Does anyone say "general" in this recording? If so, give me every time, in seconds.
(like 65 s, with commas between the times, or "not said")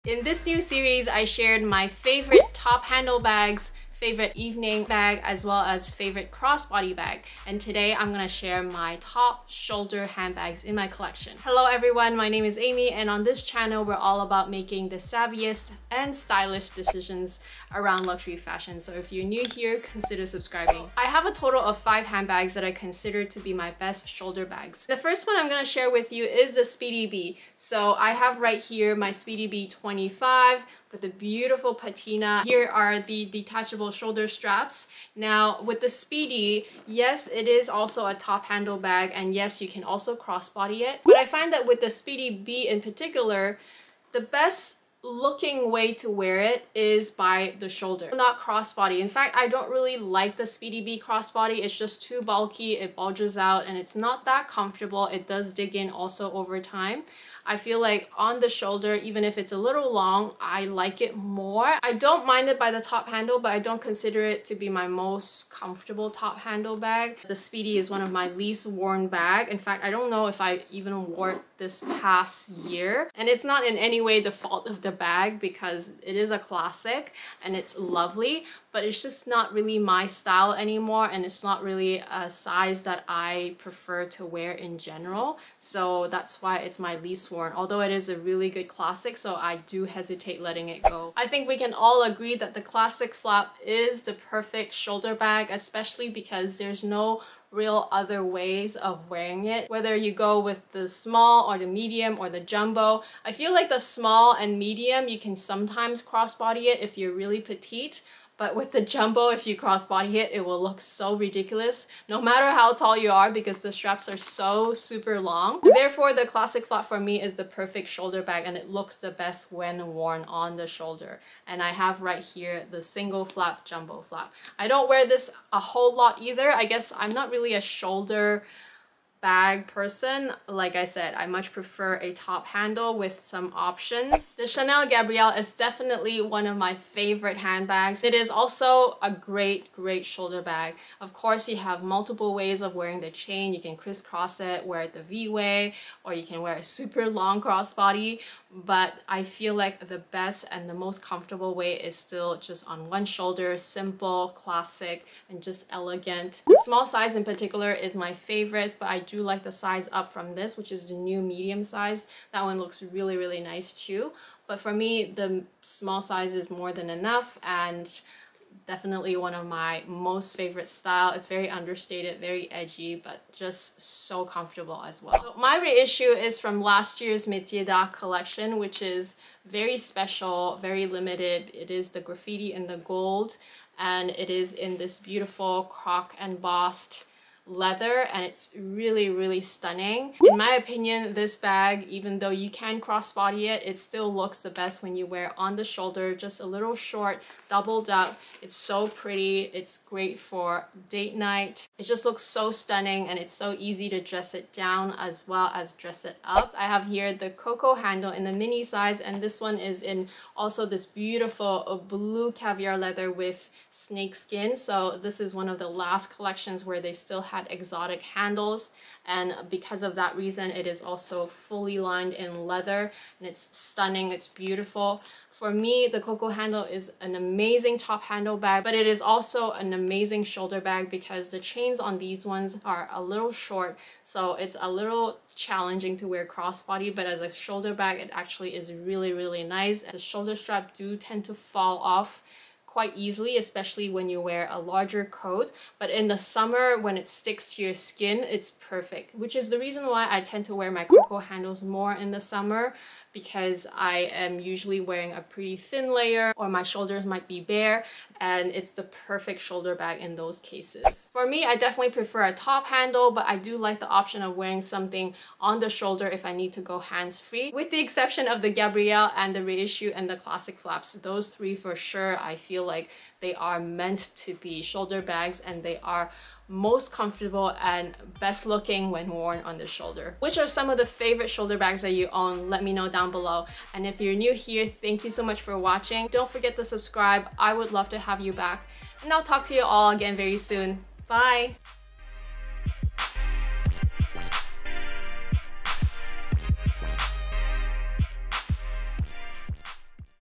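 84 s.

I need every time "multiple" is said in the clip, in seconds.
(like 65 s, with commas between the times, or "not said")
141 s.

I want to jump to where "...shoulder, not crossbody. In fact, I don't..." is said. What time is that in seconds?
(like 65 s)
47 s.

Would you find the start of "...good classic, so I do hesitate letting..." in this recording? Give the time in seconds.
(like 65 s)
88 s.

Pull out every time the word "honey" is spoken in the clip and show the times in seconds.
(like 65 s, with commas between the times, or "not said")
not said.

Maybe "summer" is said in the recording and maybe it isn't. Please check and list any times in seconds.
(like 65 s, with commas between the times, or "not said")
246 s, 252 s.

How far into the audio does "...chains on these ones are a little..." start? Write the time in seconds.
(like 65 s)
231 s.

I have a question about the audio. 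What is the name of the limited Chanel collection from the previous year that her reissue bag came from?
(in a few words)
Métier d'Art.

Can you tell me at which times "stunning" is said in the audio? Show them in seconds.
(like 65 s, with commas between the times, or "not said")
189 s, 202 s, 223 s.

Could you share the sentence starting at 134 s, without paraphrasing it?
The Chanel Gabrielle is definitely one of my favorite handbags.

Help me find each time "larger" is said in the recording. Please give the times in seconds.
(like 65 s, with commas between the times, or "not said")
244 s.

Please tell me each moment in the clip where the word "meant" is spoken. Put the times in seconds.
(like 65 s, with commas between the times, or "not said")
273 s.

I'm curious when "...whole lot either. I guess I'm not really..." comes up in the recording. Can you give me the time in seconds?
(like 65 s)
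125 s.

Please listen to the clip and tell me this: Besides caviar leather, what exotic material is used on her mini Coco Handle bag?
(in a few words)
Snake skin.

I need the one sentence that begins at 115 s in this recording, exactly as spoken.
Therefore, the classic flap for me is the perfect shoulder bag and it looks the best when worn on the shoulder.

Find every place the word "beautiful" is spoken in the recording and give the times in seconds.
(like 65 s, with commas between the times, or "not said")
31 s, 184 s, 210 s, 224 s.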